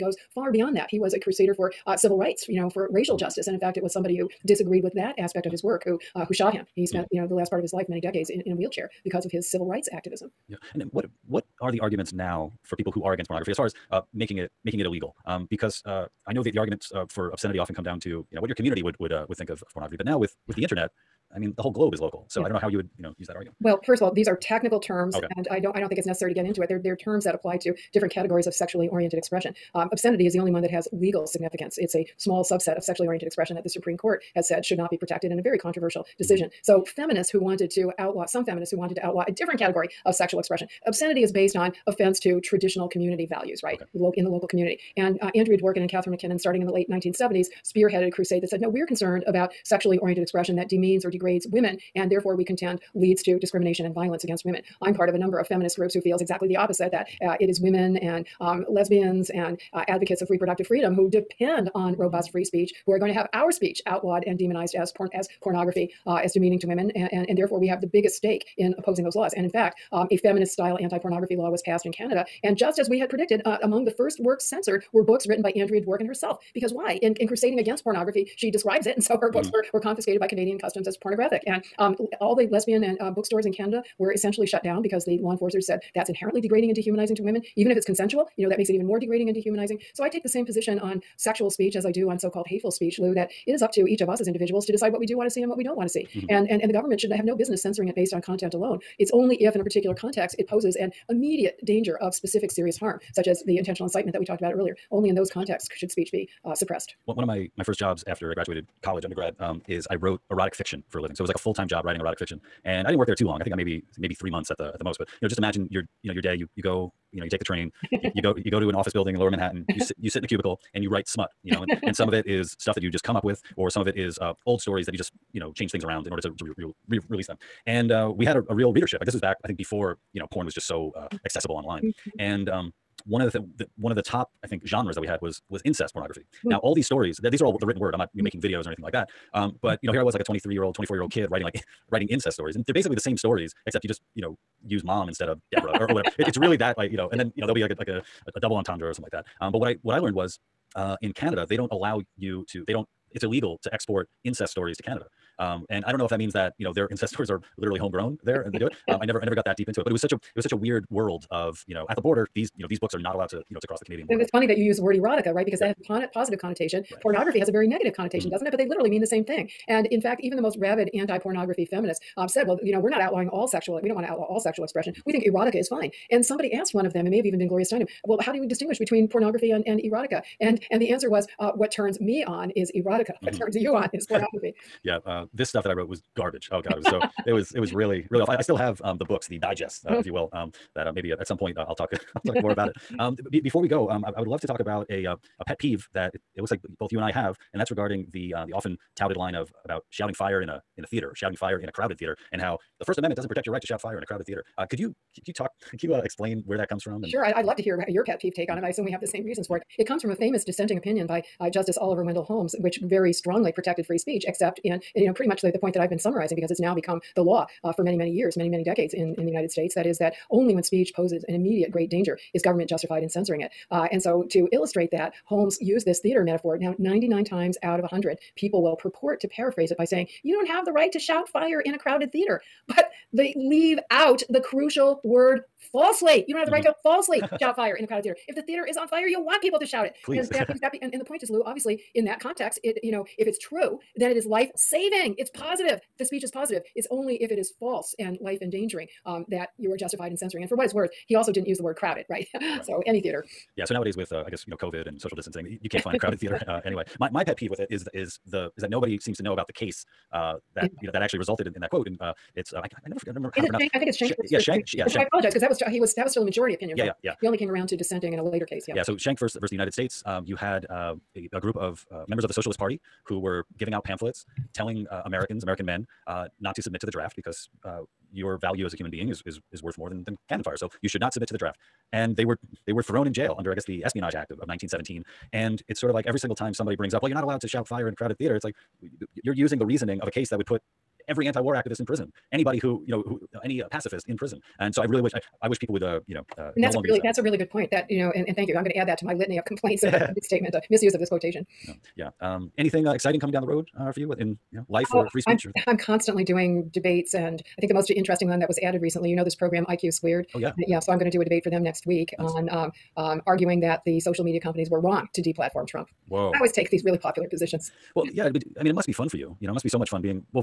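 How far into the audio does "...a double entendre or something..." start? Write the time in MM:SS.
02:28.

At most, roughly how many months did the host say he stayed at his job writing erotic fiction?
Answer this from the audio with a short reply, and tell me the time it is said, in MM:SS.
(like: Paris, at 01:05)
3, at 01:54.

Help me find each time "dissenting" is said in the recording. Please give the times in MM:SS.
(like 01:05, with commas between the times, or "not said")
03:30, 04:27.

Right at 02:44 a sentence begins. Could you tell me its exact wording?
And it's funny that you use the word erotica, right?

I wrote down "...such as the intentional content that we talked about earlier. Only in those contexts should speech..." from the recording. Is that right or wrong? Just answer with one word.
wrong.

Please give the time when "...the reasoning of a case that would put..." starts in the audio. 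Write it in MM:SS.
04:49.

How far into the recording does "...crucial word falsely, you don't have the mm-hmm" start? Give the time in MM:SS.
03:54.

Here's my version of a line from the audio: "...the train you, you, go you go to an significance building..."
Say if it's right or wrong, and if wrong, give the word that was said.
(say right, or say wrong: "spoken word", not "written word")
wrong: "office", not "significance".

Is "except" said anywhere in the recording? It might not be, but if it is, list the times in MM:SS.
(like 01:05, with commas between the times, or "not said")
02:23, 03:34.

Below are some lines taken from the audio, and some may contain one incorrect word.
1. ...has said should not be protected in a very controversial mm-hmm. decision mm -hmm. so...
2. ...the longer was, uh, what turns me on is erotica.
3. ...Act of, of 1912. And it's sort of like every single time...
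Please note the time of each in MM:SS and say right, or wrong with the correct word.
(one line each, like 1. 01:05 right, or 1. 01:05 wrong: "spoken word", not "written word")
1. 00:34 right
2. 03:00 wrong: "answer", not "longer"
3. 04:44 wrong: "1917", not "1912".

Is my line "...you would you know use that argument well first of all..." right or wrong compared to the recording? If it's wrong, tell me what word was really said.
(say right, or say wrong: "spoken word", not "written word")
right.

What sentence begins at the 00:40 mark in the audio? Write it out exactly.
Obscenity is based on offense to traditional community values, right?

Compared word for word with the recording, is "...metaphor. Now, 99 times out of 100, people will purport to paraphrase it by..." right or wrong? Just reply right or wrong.
right.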